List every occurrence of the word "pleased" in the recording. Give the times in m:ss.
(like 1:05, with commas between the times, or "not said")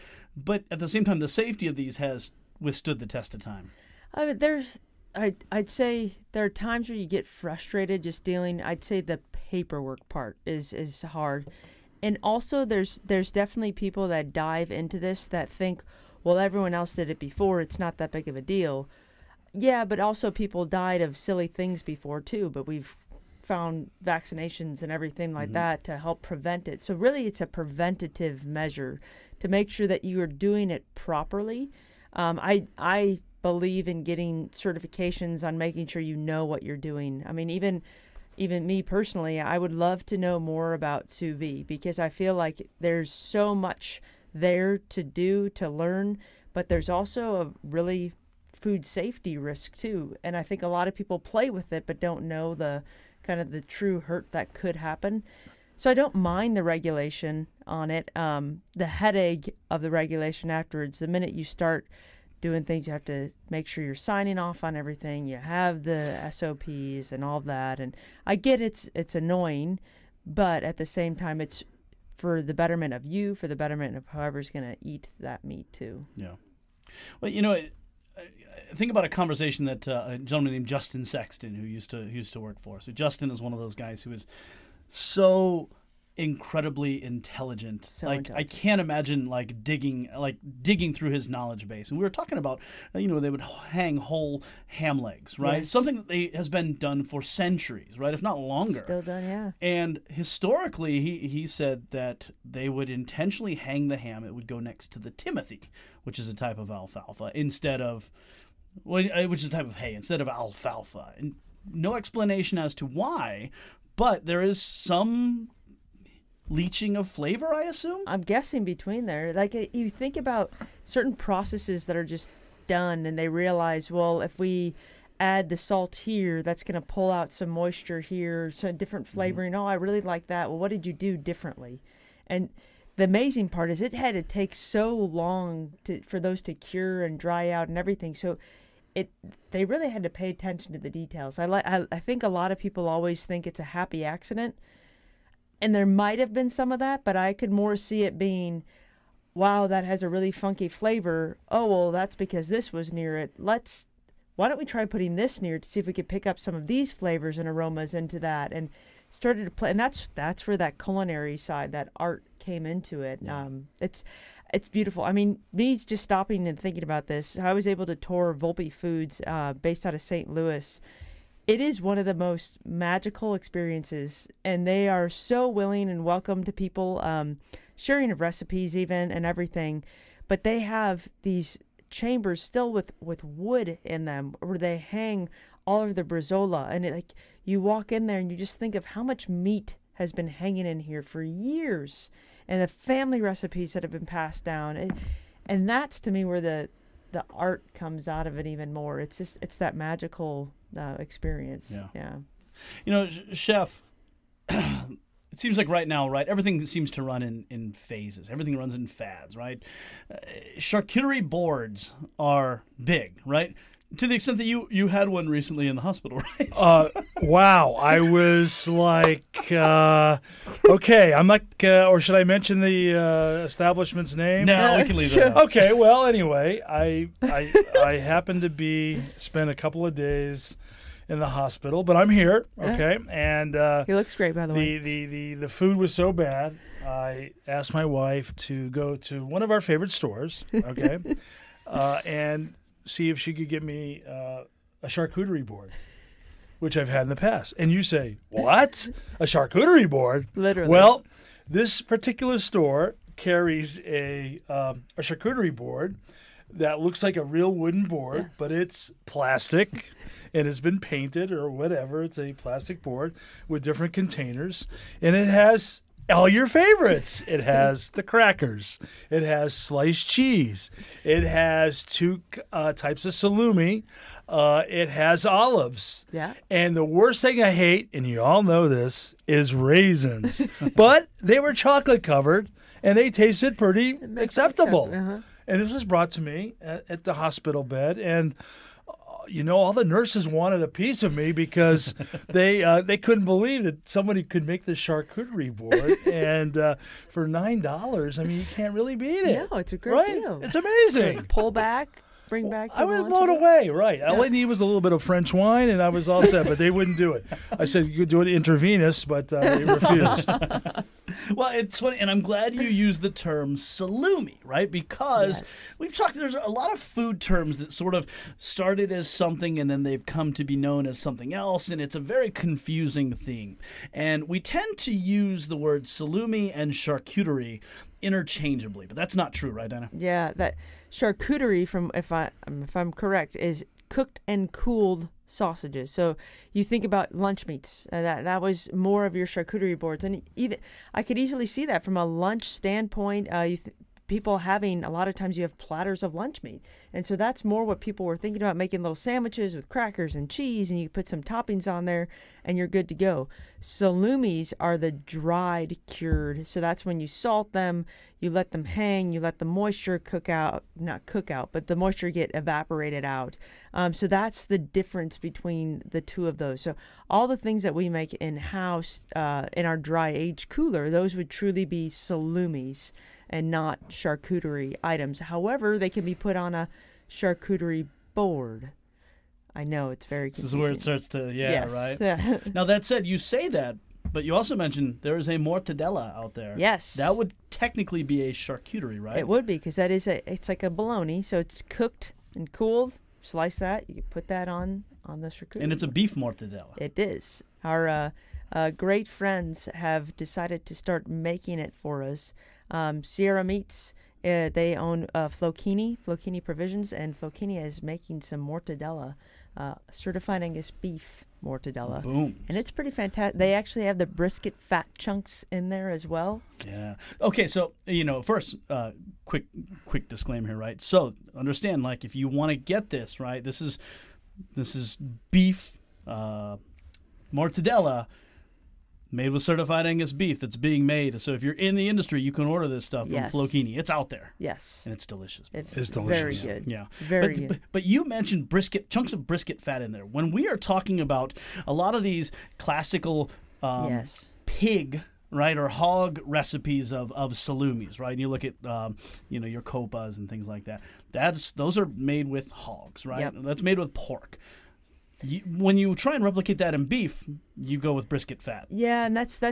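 not said.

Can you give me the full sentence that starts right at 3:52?
okay, and uh, he looks great by the, the way.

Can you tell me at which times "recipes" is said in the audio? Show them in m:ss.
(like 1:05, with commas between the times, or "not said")
2:58, 3:13, 7:26.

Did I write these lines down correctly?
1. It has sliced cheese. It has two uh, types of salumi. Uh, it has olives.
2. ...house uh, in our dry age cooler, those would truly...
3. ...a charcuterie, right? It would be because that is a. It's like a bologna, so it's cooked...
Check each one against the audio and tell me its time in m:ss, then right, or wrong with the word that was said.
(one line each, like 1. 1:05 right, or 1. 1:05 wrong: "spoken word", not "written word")
1. 4:29 right
2. 6:08 right
3. 6:28 right.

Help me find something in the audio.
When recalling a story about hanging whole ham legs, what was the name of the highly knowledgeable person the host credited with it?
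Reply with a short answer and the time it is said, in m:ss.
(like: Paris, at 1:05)
Justin Sexton, at 1:20.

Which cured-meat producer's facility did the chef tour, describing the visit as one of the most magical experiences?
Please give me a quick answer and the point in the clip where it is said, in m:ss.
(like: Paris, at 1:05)
Volpi Foods, at 2:48.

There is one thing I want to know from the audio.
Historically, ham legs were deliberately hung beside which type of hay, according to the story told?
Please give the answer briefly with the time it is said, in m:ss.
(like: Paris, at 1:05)
timothy, at 1:45.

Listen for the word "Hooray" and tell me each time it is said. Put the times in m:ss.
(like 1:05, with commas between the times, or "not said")
not said.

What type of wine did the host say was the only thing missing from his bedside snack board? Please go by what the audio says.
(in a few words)
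French wine.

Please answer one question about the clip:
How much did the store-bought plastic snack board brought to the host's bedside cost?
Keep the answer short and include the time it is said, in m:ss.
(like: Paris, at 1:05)
$9, at 4:57.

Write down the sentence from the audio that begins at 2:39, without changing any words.
And that's, that's where that culinary side, that art came into it.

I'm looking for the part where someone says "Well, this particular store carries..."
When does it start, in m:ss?
4:10.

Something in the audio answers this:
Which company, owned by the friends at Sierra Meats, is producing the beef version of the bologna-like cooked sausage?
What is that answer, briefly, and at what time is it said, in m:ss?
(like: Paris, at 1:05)
Flokini Provisions, at 6:46.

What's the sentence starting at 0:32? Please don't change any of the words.
Um, I I believe in getting certifications on making sure you know what you're doing.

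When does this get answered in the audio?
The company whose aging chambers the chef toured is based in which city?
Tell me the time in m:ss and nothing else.
2:50.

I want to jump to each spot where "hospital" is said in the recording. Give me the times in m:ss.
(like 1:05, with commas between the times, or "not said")
3:35, 3:51, 4:47.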